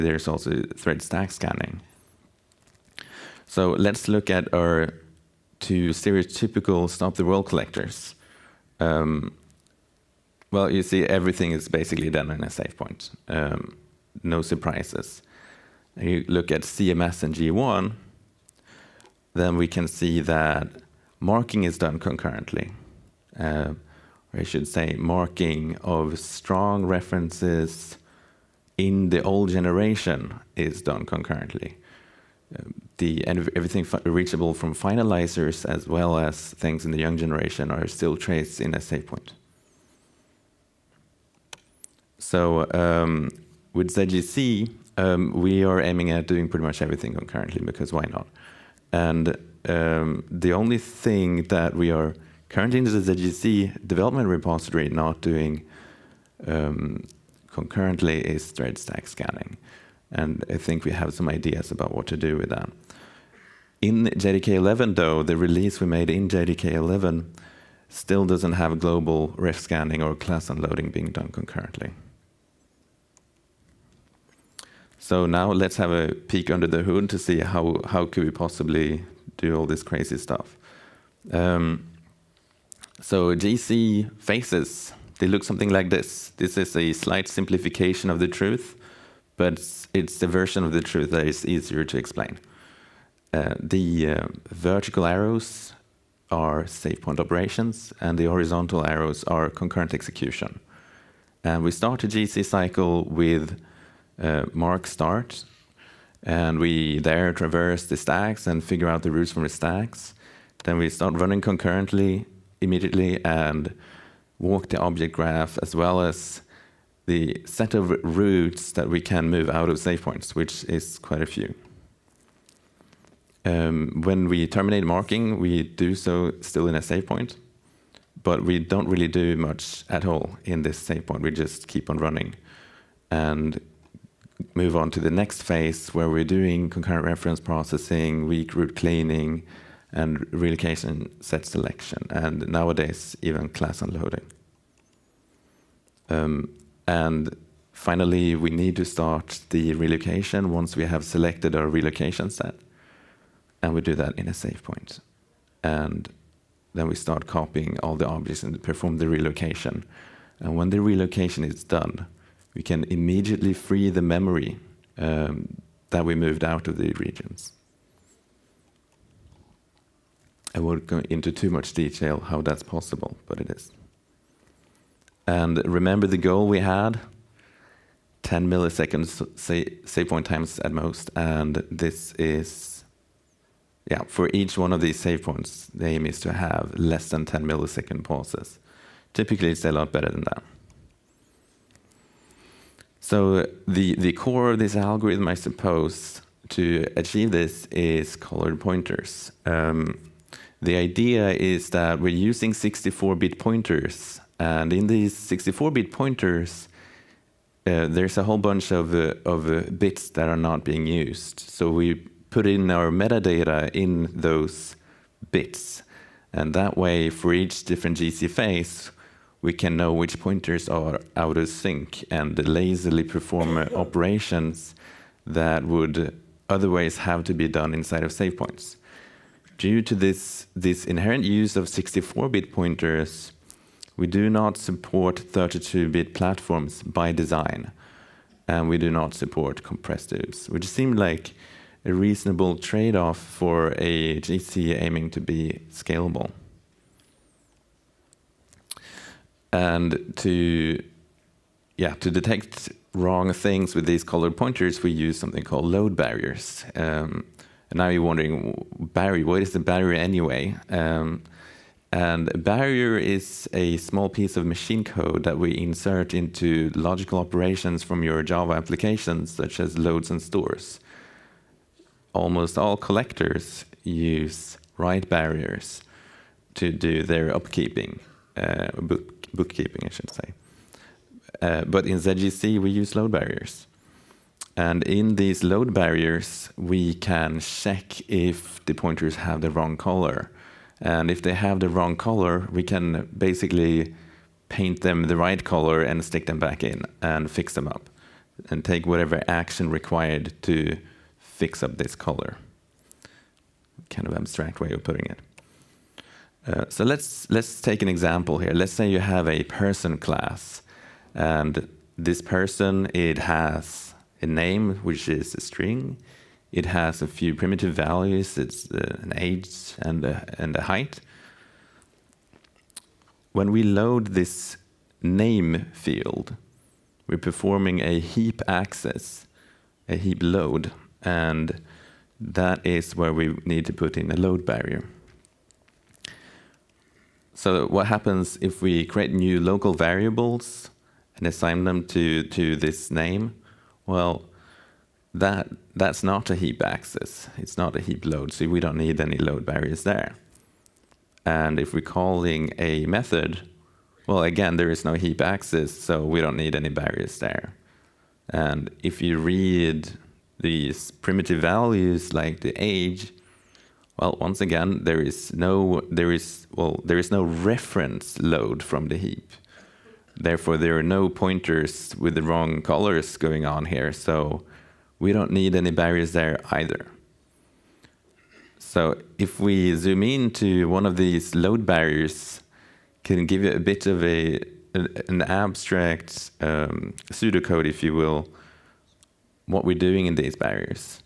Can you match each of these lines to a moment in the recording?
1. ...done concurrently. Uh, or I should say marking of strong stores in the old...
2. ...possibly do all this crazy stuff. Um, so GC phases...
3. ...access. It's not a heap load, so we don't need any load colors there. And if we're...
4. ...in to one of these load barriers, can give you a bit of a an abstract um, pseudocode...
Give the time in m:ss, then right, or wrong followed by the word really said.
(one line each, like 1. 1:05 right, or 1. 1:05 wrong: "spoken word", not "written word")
1. 0:21 wrong: "references", not "stores"
2. 1:18 right
3. 5:46 wrong: "barriers", not "colors"
4. 6:20 right.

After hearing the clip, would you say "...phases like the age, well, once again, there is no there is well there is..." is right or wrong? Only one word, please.
wrong.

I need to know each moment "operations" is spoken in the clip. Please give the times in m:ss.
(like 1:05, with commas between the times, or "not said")
1:37, 3:43, 4:27.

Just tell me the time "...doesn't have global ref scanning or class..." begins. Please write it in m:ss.
1:08.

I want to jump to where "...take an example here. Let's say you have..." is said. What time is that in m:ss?
5:07.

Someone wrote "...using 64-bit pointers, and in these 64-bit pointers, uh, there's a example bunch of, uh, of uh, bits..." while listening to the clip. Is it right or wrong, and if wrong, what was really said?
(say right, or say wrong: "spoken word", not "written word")
wrong: "whole", not "example".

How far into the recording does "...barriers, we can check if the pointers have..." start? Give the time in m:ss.
4:45.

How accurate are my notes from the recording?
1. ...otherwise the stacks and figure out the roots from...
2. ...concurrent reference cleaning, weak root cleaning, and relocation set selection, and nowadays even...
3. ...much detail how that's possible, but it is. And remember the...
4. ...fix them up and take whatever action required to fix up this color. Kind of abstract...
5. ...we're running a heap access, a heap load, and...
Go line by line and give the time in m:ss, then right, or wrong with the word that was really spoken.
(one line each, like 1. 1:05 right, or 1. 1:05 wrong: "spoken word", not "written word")
1. 1:47 wrong: "traverse", not "otherwise"
2. 2:16 wrong: "processing", not "cleaning"
3. 2:51 right
4. 4:57 right
5. 5:27 wrong: "performing", not "running".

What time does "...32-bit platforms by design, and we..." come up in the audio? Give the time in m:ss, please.
3:55.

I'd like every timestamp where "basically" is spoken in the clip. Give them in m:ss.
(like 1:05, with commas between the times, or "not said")
0:11, 4:53.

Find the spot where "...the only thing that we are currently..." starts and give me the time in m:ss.
0:50.